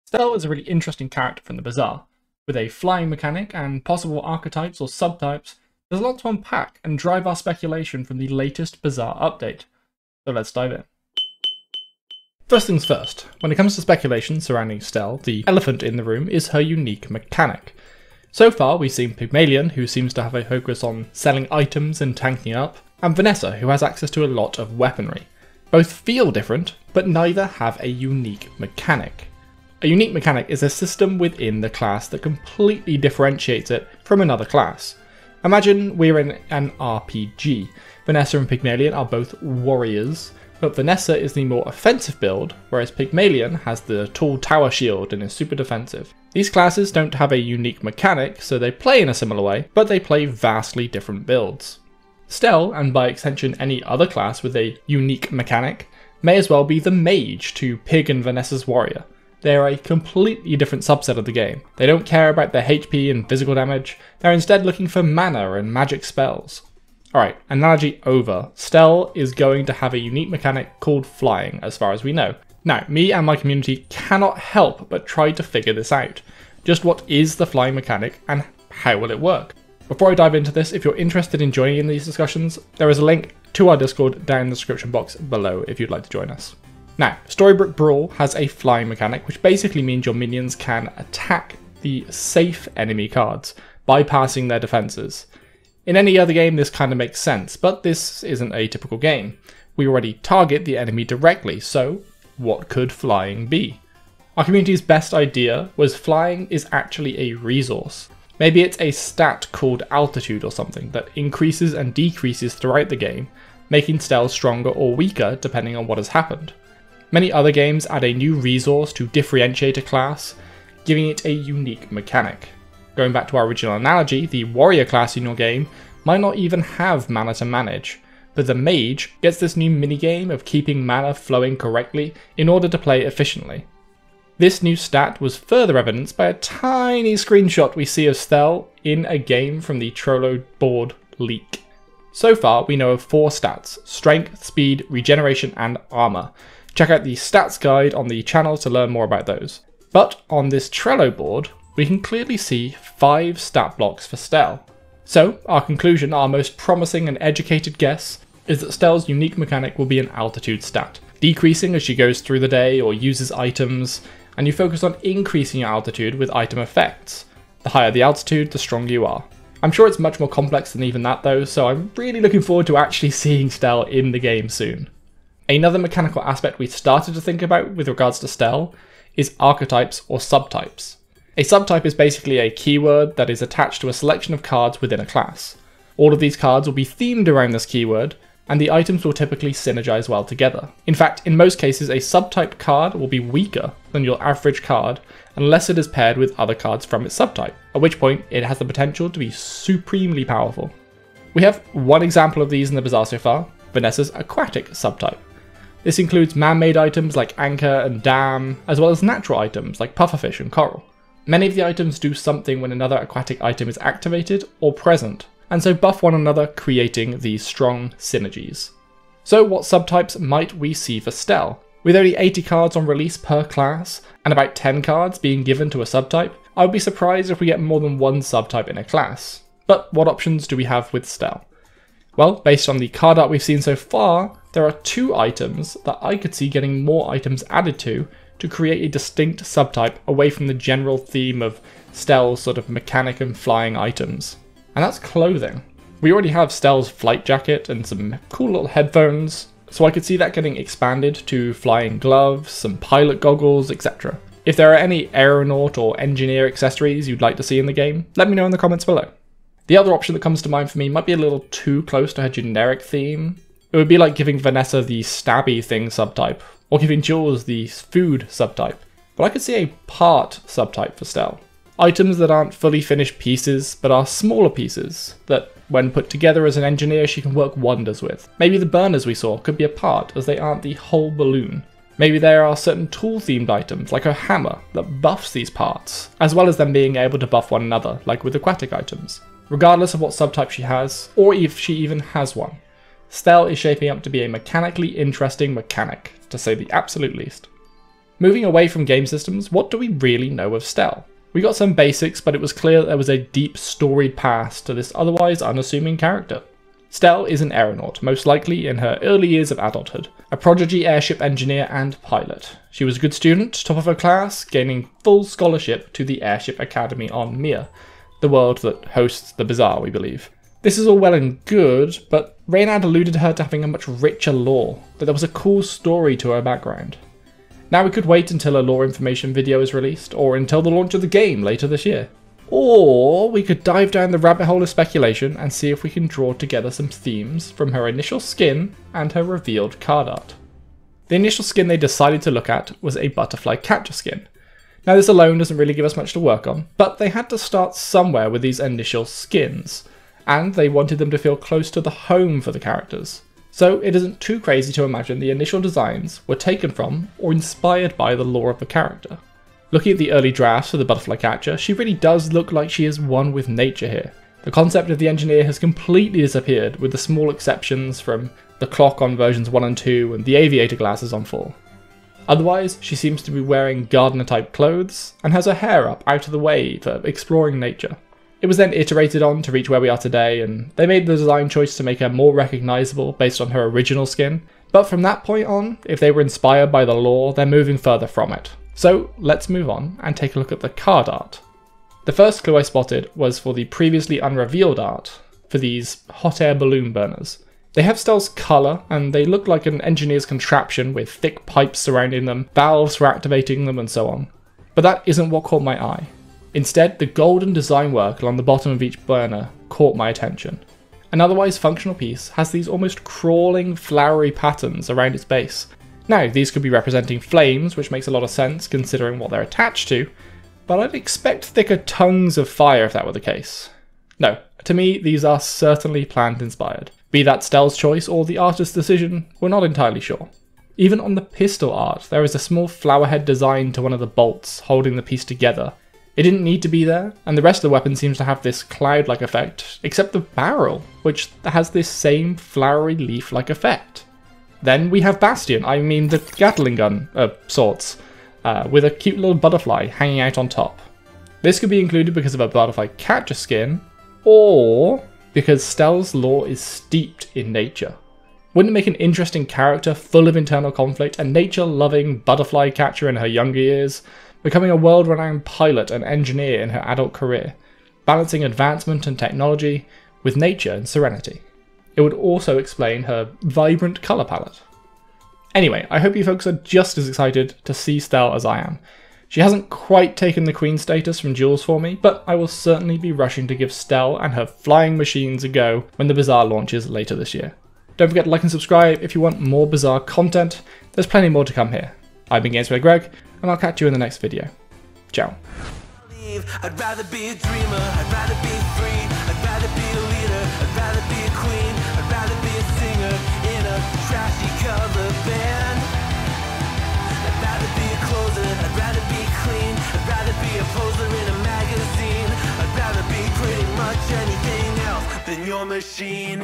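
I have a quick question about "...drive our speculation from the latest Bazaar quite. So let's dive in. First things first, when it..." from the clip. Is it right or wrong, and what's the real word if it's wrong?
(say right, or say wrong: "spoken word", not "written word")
wrong: "update", not "quite".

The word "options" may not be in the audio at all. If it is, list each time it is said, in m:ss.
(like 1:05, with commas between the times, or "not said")
3:50, 4:19.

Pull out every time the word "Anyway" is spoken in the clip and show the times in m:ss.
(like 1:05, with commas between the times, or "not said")
7:55.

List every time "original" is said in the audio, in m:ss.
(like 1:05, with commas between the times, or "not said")
2:03, 6:23.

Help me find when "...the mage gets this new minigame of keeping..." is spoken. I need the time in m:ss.
2:08.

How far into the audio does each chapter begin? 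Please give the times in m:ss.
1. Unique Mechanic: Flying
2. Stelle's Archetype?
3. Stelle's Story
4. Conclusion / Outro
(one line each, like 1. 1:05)
1. 0:11
2. 2:54
3. 4:57
4. 8:00.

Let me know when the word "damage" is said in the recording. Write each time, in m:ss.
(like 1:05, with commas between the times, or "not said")
1:03.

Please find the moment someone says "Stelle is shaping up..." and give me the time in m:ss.
4:53.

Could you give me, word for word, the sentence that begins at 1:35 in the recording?
In any other game, this kind of makes sense, but this isn't a typical game.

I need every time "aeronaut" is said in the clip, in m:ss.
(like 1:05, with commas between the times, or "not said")
4:15, 5:07.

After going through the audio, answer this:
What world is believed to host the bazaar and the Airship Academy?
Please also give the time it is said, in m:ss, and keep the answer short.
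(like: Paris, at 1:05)
Mir, at 5:17.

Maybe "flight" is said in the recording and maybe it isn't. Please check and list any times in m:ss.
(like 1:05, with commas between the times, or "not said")
4:06.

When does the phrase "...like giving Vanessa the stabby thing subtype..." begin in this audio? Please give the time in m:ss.
4:23.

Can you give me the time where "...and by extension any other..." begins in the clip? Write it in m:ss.
0:52.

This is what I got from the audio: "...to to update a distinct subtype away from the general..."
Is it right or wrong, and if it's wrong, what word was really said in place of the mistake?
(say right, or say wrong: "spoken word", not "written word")
wrong: "create", not "update".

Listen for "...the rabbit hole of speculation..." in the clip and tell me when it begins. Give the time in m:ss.
5:34.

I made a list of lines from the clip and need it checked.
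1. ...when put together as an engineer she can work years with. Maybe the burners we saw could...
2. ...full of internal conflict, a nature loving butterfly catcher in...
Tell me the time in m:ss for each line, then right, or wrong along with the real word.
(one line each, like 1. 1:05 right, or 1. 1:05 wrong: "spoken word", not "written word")
1. 4:35 wrong: "wonders", not "years"
2. 7:39 right.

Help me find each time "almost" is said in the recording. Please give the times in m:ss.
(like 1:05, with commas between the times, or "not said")
6:52.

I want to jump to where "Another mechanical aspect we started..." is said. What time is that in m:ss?
2:55.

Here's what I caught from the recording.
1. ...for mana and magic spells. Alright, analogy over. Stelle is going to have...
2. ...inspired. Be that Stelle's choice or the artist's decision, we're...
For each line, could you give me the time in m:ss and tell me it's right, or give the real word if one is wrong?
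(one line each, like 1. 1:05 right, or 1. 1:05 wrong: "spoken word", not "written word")
1. 1:04 right
2. 7:06 right.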